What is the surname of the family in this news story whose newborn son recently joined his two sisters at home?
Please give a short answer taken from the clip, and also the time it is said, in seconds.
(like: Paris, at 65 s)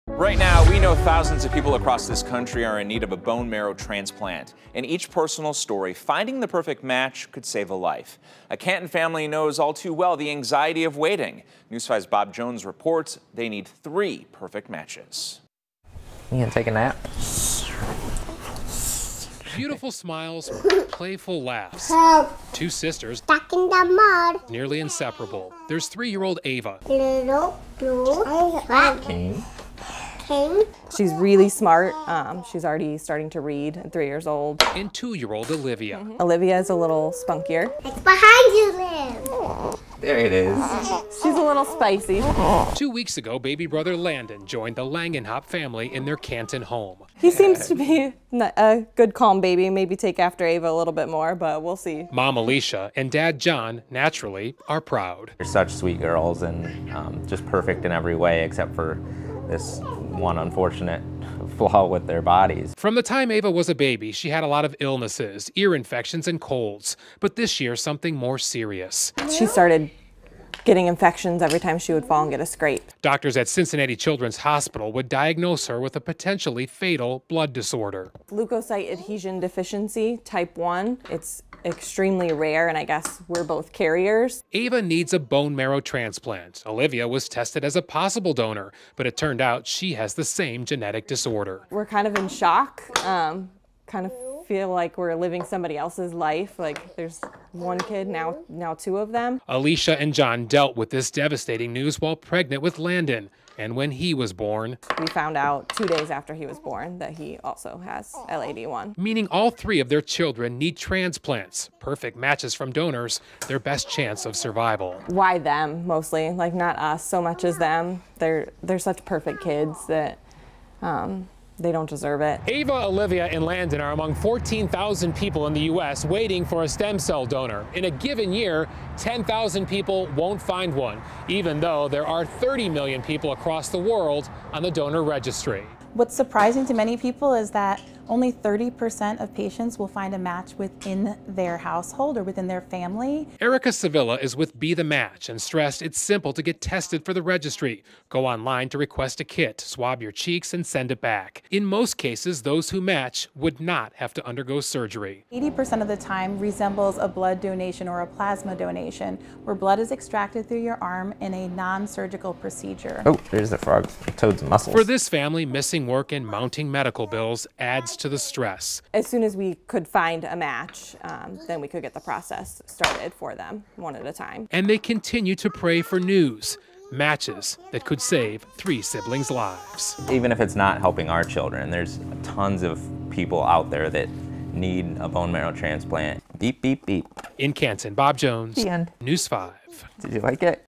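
Langenhop, at 44 s.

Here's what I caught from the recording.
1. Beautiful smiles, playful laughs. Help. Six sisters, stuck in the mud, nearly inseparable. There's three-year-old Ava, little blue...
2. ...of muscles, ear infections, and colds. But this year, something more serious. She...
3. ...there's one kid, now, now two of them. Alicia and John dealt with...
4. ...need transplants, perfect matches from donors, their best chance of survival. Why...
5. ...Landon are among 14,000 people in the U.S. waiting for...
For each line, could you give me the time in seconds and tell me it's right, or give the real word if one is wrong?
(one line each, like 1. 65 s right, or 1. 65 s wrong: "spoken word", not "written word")
1. 19 s wrong: "Two", not "Six"
2. 64 s wrong: "illnesses", not "muscles"
3. 96 s right
4. 110 s right
5. 123 s right.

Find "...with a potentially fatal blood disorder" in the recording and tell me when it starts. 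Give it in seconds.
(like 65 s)
75 s.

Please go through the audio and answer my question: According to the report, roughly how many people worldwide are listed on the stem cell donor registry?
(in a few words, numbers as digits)
30 million.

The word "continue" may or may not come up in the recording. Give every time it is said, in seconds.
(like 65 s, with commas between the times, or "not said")
174 s.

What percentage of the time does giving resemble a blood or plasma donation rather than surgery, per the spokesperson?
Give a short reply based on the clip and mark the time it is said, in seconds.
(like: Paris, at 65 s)
80%, at 155 s.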